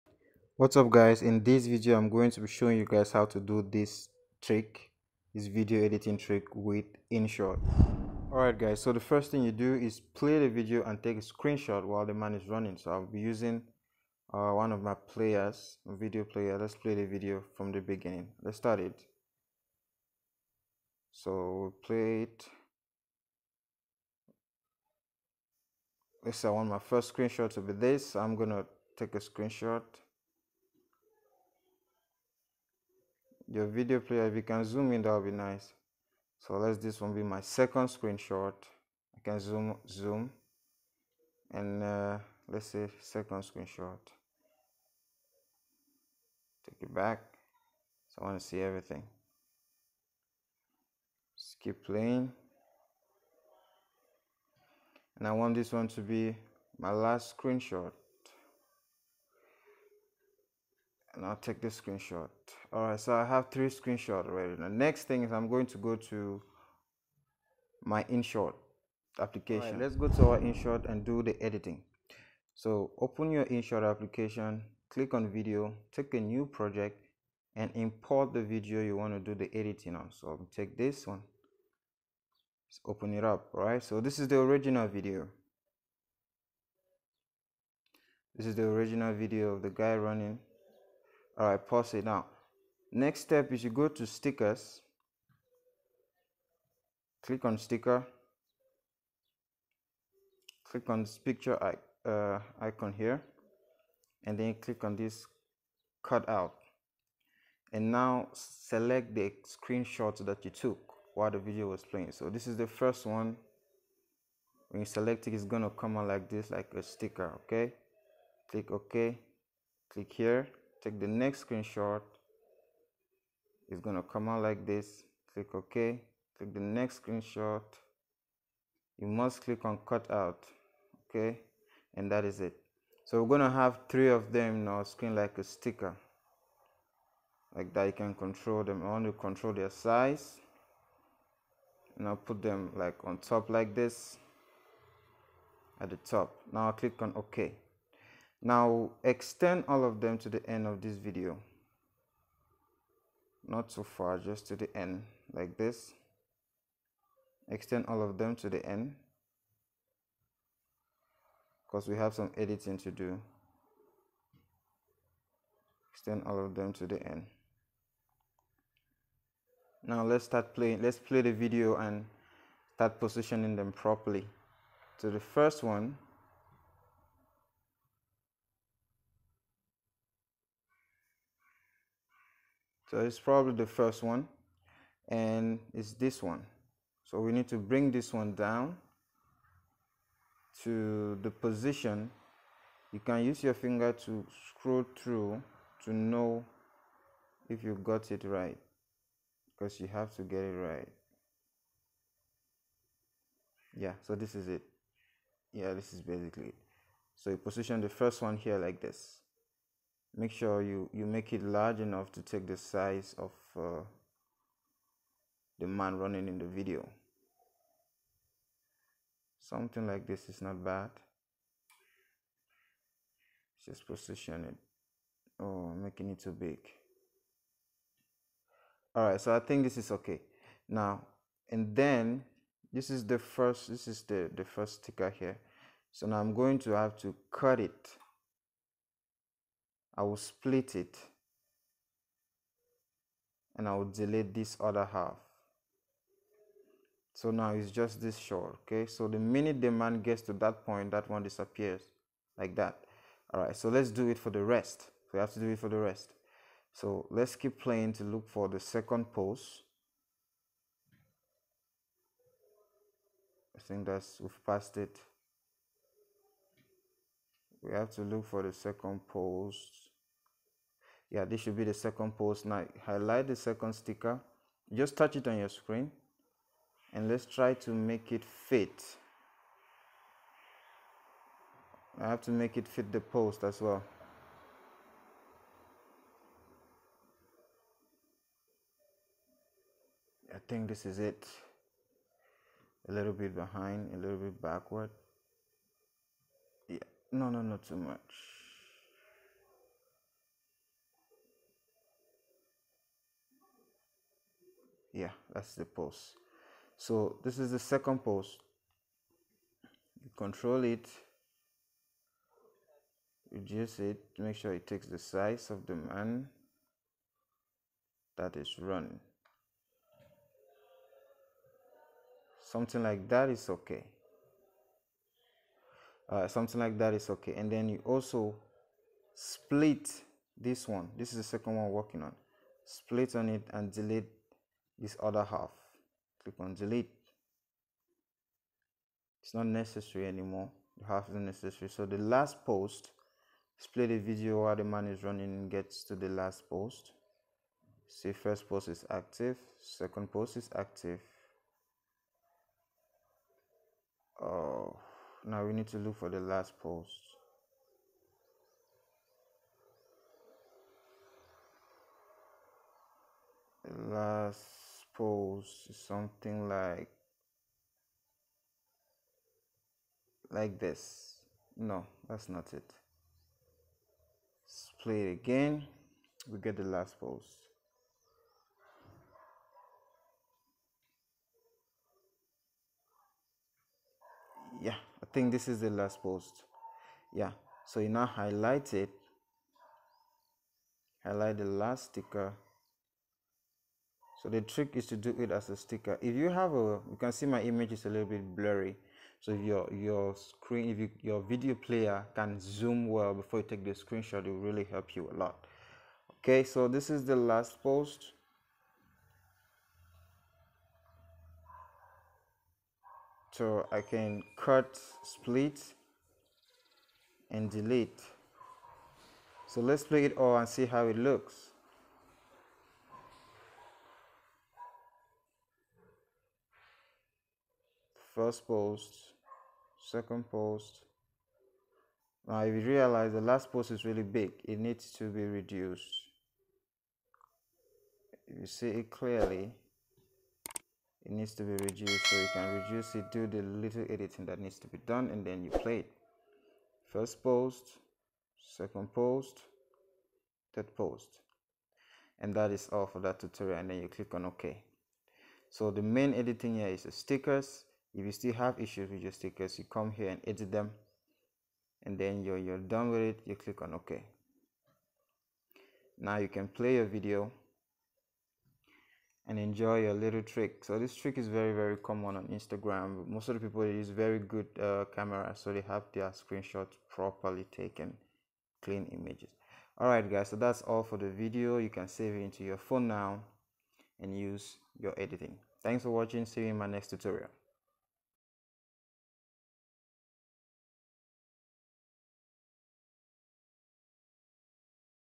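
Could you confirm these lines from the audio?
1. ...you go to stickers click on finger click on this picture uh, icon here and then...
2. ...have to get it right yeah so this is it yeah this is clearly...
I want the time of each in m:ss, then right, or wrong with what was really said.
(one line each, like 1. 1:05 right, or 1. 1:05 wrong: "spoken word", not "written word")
1. 1:33 wrong: "sticker", not "finger"
2. 3:19 wrong: "basically", not "clearly".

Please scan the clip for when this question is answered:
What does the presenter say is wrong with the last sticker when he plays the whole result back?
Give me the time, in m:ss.
7:13.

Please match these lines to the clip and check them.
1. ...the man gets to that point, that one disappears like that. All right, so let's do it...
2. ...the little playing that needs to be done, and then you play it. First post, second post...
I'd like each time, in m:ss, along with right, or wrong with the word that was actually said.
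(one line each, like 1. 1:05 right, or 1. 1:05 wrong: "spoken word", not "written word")
1. 4:09 right
2. 7:23 wrong: "editing", not "playing".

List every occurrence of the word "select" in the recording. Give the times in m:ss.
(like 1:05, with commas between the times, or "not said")
1:48, 1:54.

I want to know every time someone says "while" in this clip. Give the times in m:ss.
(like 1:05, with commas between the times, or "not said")
0:11, 1:51, 5:44.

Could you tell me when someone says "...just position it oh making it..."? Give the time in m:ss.
3:43.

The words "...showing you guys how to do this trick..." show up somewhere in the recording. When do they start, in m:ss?
0:02.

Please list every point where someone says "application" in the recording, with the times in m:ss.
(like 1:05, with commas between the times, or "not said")
1:09, 1:13.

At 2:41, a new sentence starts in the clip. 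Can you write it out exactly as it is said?
Because we have some editing to do.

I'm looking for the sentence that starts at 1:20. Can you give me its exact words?
So I'll take this one, let's open it up, all right?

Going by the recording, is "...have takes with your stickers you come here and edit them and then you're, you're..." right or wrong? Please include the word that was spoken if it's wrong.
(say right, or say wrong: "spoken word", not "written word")
wrong: "issues", not "takes".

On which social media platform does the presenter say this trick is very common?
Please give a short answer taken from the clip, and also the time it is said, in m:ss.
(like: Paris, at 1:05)
Instagram, at 7:52.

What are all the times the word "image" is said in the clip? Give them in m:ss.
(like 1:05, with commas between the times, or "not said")
6:37, 7:58.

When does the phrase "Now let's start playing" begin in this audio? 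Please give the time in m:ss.
2:49.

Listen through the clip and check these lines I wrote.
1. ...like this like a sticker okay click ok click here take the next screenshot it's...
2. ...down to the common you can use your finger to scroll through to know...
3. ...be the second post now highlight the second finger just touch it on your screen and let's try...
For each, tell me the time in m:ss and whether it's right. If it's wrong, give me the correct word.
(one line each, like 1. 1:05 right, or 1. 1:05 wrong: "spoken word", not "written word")
1. 1:56 right
2. 3:08 wrong: "position", not "common"
3. 4:31 wrong: "sticker", not "finger".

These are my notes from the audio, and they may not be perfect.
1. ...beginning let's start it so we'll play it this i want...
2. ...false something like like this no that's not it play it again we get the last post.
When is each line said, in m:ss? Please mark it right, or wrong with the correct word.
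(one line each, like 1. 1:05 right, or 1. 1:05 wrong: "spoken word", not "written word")
1. 0:17 right
2. 6:05 right.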